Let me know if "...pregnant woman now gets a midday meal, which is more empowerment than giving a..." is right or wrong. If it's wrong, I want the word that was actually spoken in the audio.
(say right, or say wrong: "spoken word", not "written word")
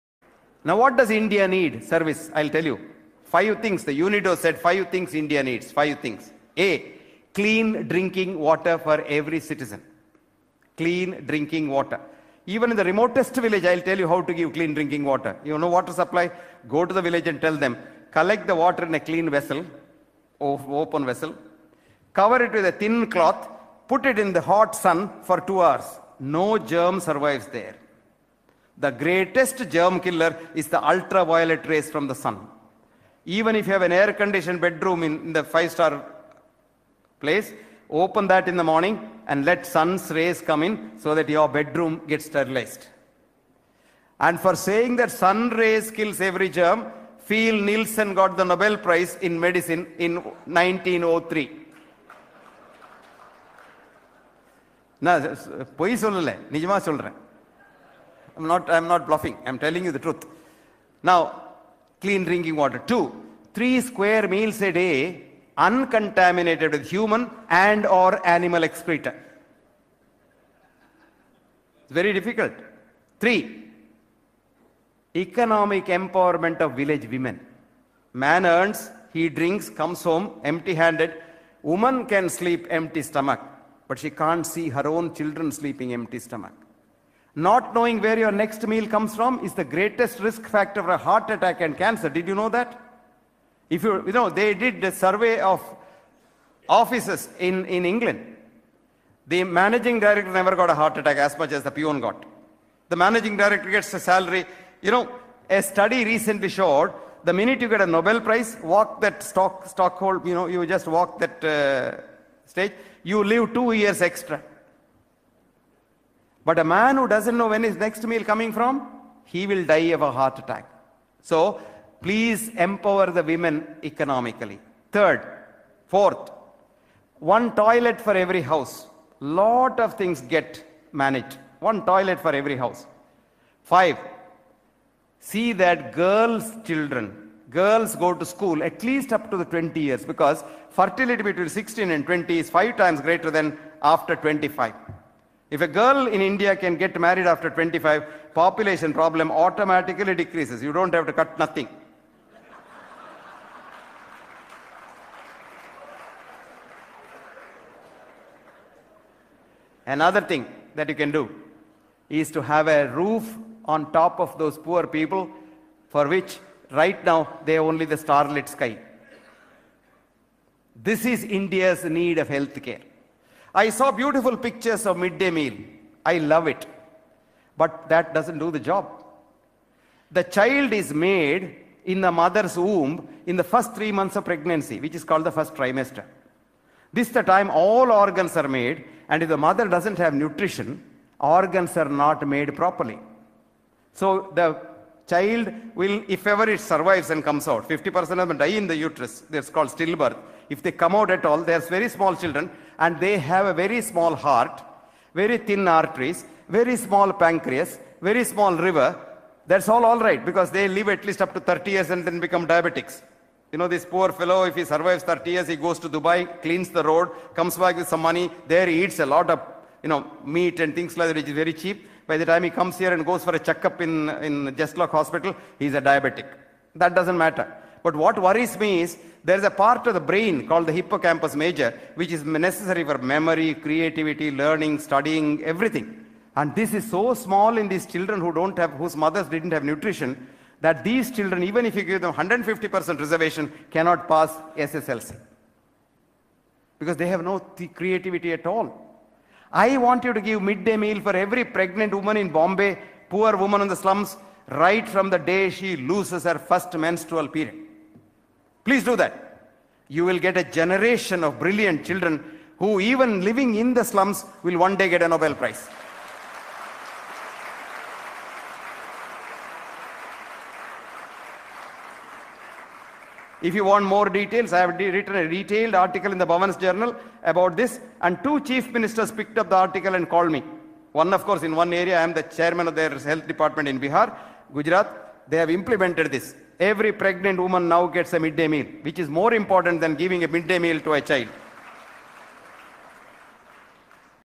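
wrong: "important", not "empowerment".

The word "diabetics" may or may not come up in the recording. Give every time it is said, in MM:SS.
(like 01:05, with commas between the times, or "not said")
03:32, 03:45.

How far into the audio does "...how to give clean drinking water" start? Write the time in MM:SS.
00:14.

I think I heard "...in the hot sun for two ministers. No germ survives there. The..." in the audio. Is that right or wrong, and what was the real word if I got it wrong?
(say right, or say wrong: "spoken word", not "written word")
wrong: "hours", not "ministers".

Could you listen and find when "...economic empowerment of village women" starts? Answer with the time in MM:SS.
01:15.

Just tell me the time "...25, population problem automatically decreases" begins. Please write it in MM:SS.
02:27.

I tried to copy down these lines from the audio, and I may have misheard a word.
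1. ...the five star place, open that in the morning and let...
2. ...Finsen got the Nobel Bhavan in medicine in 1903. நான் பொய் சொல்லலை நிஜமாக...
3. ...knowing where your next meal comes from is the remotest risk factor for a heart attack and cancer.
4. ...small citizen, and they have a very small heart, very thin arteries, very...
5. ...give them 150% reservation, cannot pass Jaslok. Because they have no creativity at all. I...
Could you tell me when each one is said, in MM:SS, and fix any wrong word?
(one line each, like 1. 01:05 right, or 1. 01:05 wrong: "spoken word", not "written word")
1. 00:35 right
2. 00:47 wrong: "Prize", not "Bhavan"
3. 01:27 wrong: "greatest", not "remotest"
4. 03:21 wrong: "children", not "citizen"
5. 04:01 wrong: "SSLC", not "Jaslok".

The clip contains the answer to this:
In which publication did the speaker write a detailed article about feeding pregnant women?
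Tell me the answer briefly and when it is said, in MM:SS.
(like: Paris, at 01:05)
Bhavan's Journal, at 04:36.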